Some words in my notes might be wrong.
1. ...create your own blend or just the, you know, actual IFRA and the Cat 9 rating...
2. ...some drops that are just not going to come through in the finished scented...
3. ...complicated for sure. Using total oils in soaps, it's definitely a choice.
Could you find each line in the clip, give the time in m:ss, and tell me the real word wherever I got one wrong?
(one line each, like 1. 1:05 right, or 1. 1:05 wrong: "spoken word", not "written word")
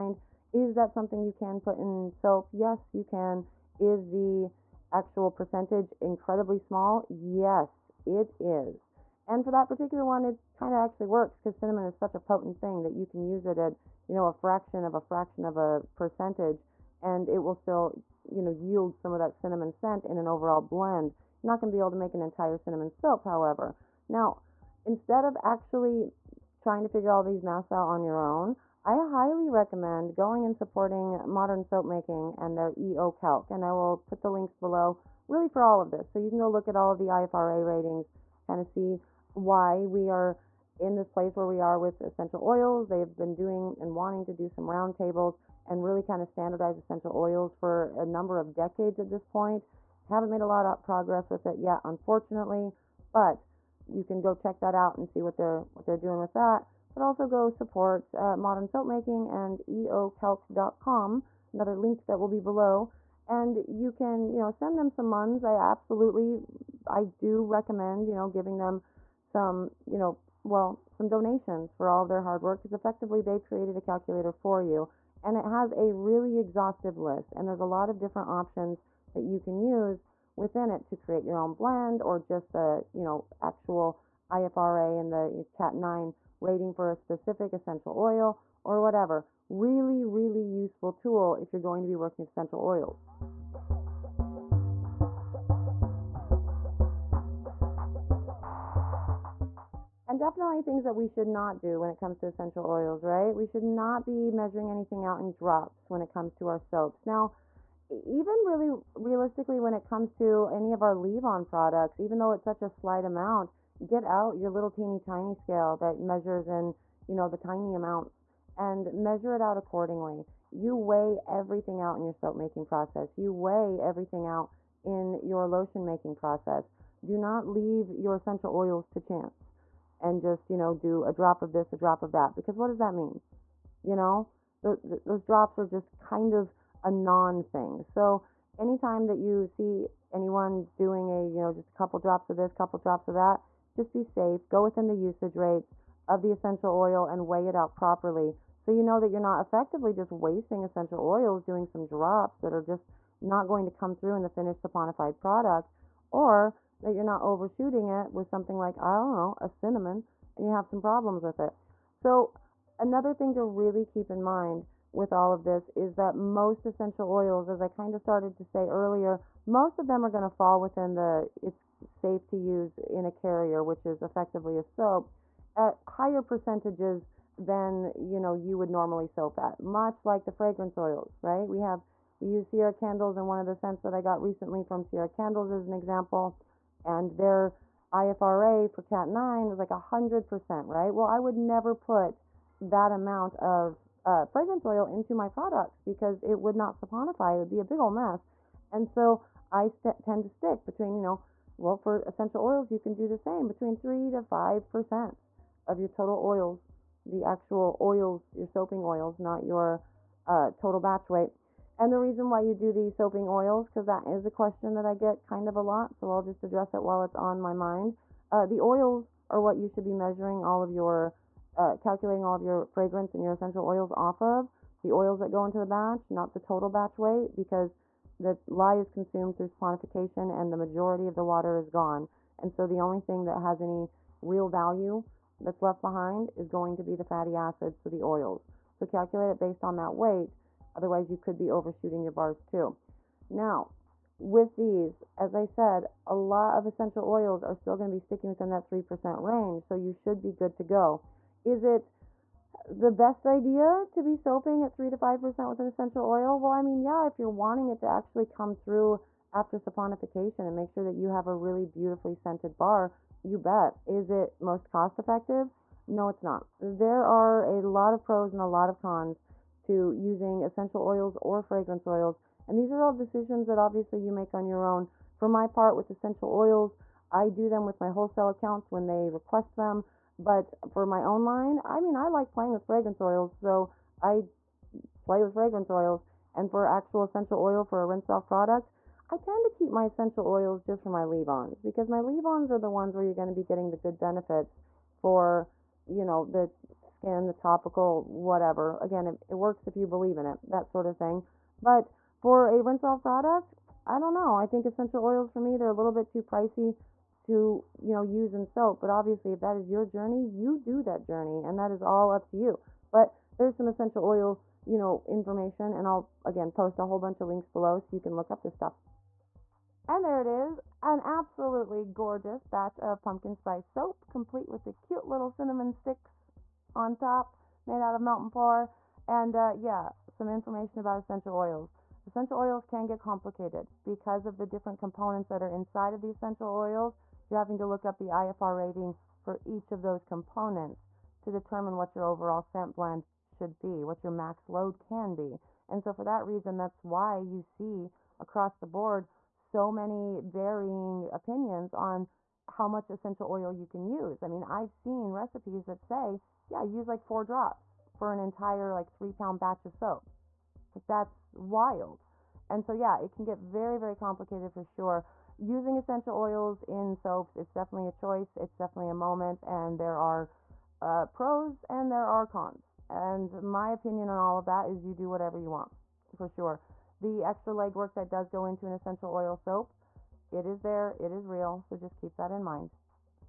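1. 1:20 right
2. 2:31 wrong: "saponified", not "scented"
3. 6:03 wrong: "essential", not "total".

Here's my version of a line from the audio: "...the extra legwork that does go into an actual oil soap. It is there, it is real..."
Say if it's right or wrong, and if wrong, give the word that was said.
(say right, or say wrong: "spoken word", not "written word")
wrong: "essential", not "actual".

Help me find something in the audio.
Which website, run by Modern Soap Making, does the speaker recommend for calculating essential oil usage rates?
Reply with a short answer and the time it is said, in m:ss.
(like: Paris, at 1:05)
eocalc.com, at 0:59.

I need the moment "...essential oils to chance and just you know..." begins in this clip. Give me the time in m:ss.
2:08.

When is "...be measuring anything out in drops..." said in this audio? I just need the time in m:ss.
1:44.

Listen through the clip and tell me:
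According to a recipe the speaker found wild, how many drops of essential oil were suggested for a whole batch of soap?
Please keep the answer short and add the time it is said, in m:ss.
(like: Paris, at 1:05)
4 drops, at 5:57.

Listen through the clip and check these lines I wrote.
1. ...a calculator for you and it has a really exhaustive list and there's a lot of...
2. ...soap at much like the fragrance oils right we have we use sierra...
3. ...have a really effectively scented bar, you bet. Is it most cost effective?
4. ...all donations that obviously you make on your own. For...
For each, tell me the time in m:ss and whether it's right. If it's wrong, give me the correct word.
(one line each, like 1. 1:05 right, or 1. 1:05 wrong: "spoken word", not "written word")
1. 1:13 right
2. 2:59 right
3. 4:21 wrong: "beautifully", not "effectively"
4. 4:32 wrong: "decisions", not "donations".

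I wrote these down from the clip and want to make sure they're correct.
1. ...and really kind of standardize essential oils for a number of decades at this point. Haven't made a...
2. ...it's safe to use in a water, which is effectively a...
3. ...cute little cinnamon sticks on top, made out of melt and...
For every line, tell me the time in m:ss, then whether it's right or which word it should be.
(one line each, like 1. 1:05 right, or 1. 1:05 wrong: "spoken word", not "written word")
1. 0:45 right
2. 2:51 wrong: "carrier", not "water"
3. 5:24 right.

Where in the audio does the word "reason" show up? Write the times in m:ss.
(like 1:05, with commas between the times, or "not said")
3:31, 5:46.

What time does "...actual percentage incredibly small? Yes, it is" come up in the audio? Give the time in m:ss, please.
0:04.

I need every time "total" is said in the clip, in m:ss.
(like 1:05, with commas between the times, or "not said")
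3:25, 3:30, 3:46.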